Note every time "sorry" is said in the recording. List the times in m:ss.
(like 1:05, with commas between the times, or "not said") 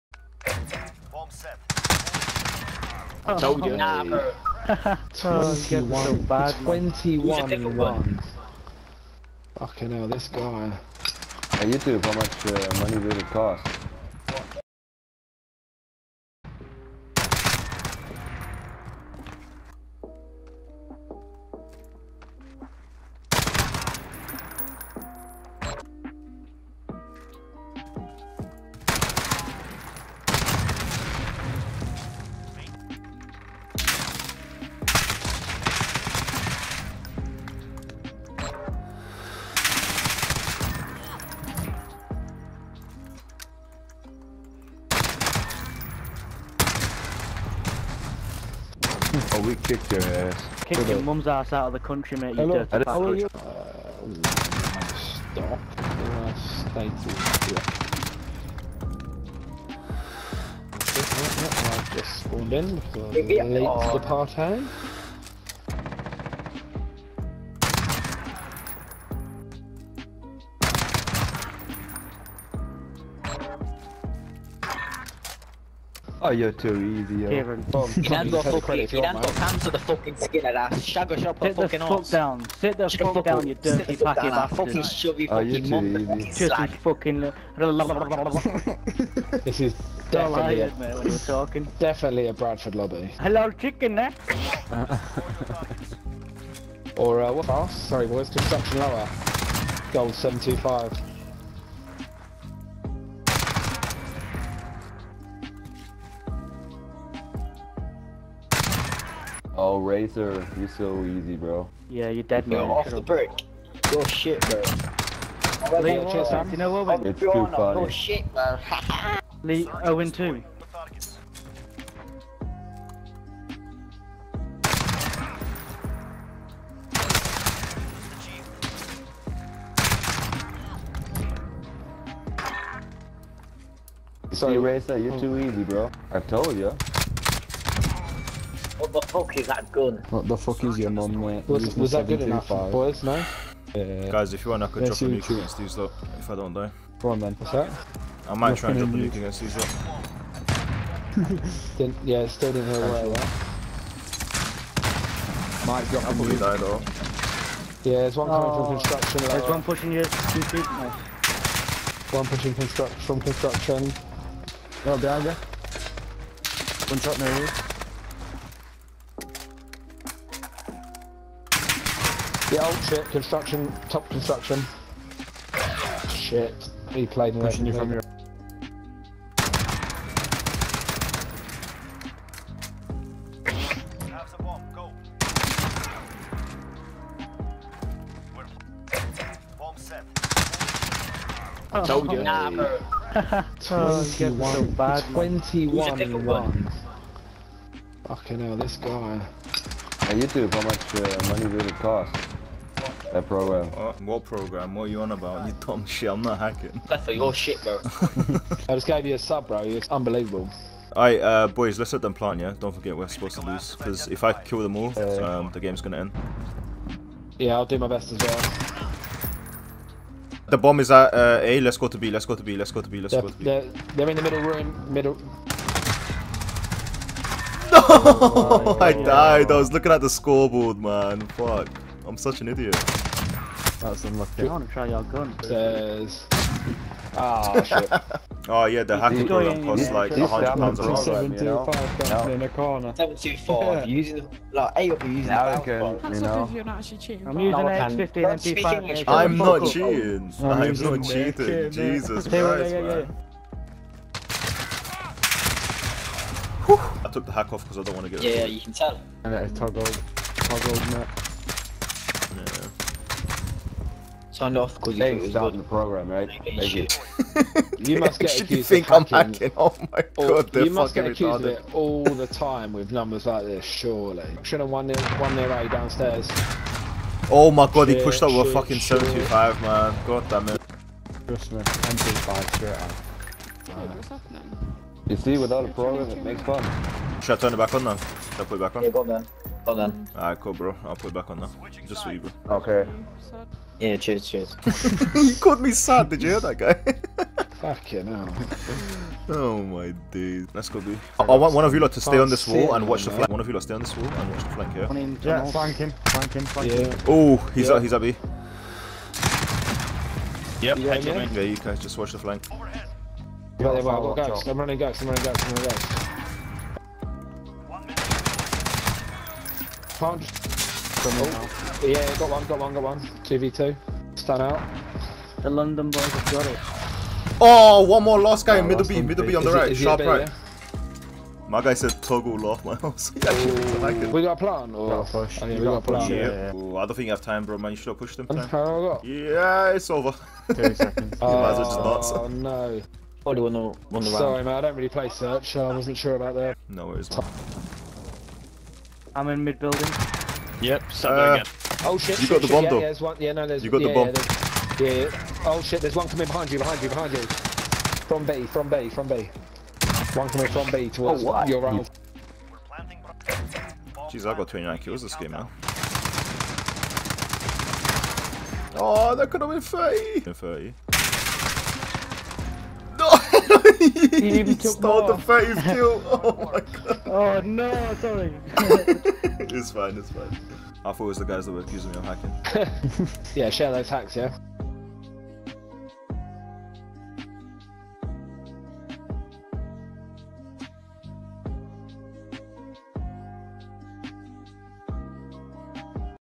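1:37, 2:14, 5:44, 6:17.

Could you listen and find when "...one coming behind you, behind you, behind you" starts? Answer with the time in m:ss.
5:55.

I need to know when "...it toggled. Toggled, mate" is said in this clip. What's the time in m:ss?
4:19.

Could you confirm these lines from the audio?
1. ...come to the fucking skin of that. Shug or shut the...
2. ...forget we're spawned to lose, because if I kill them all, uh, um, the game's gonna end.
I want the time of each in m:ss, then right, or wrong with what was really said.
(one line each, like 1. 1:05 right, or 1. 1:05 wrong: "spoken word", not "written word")
1. 1:19 right
2. 3:32 wrong: "supposed", not "spawned".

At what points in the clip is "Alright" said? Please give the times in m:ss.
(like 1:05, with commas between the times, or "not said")
3:30, 4:50.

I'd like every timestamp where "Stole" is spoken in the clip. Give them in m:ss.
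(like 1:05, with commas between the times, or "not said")
6:14.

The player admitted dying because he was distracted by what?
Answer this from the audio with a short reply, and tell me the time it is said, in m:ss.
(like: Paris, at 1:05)
The scoreboard, at 3:50.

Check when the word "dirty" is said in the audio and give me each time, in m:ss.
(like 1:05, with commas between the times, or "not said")
0:52, 1:23.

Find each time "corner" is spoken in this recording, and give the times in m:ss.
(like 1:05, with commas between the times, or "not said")
4:02.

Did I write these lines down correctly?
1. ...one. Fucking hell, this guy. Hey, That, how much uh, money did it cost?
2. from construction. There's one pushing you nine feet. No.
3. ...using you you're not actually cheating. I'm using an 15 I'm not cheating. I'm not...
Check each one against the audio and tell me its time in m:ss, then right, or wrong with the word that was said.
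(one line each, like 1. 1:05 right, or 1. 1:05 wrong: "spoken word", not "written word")
1. 0:07 wrong: "YouTube", not "That"
2. 2:38 wrong: "two", not "nine"
3. 4:05 right.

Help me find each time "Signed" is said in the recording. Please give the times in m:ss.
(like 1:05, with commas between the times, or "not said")
4:24.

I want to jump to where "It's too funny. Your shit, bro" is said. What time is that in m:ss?
1:57.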